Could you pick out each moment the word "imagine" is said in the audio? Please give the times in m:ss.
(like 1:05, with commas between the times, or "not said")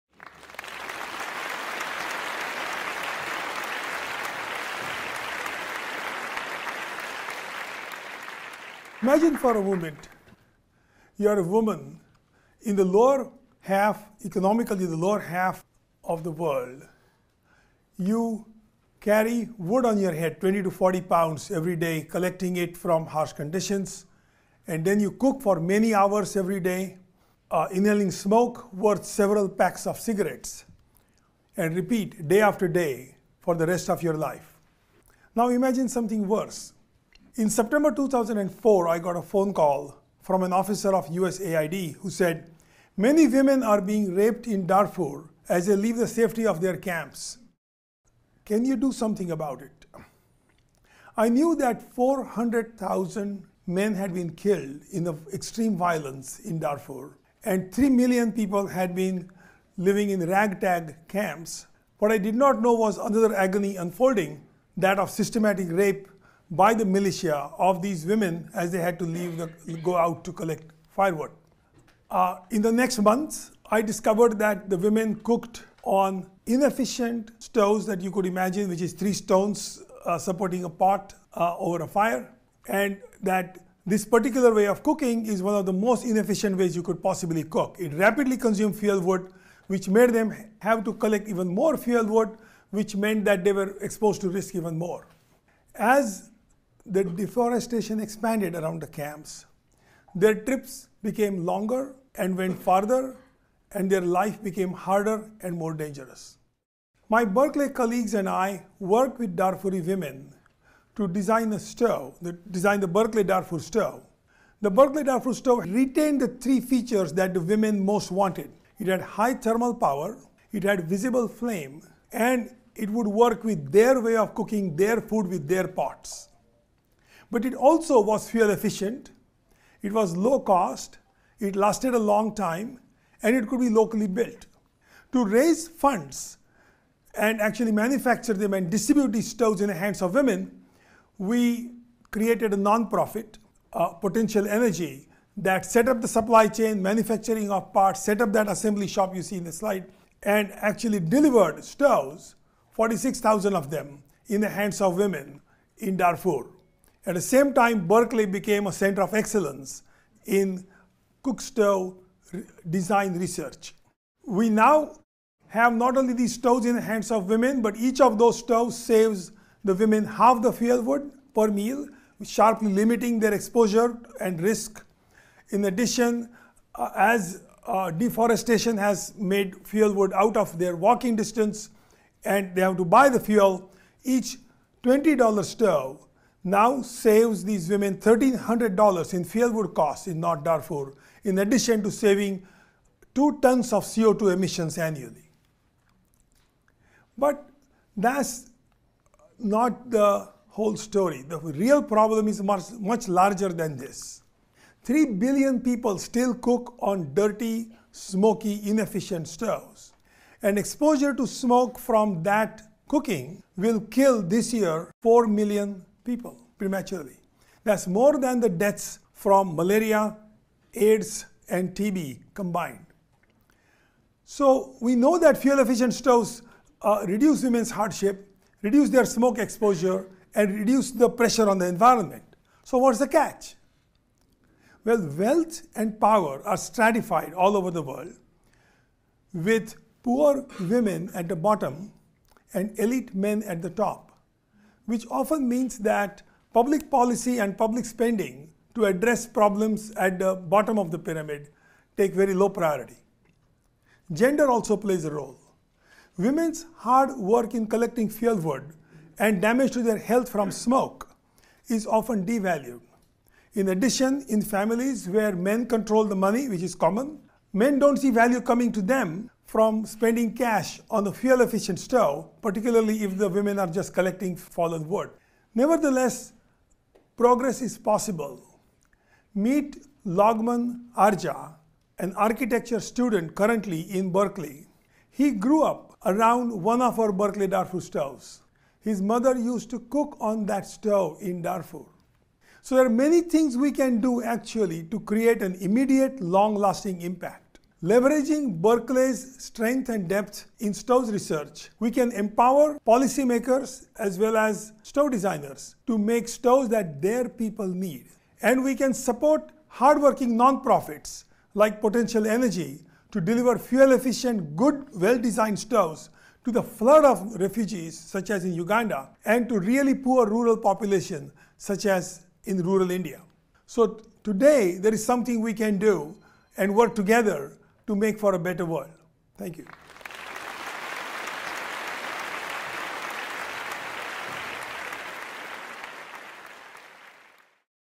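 0:09, 0:35, 1:18.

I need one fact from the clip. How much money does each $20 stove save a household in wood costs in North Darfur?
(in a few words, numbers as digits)
$1,300.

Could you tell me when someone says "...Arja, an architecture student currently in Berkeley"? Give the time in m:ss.
4:40.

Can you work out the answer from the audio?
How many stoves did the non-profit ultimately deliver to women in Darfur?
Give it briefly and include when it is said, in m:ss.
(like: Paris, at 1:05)
46,000, at 2:32.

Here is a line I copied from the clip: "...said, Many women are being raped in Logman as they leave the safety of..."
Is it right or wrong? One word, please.
wrong.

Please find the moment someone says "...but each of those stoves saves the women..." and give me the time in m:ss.
2:47.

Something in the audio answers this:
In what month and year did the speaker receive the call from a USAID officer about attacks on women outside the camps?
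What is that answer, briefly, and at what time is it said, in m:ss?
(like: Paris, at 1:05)
September 2004, at 0:37.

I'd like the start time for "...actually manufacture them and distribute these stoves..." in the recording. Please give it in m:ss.
2:17.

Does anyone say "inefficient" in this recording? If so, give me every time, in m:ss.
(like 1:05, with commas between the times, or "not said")
1:16, 1:26, 3:28.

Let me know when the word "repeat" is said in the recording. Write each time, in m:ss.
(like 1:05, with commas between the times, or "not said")
0:31.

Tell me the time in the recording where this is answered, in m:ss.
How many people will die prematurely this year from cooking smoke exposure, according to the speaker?
3:35.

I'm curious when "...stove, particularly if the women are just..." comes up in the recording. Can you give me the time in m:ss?
4:31.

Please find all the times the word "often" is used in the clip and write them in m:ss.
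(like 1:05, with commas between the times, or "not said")
4:05, 4:21.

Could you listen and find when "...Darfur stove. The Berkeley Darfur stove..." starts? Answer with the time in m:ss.
1:53.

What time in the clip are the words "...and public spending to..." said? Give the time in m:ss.
4:07.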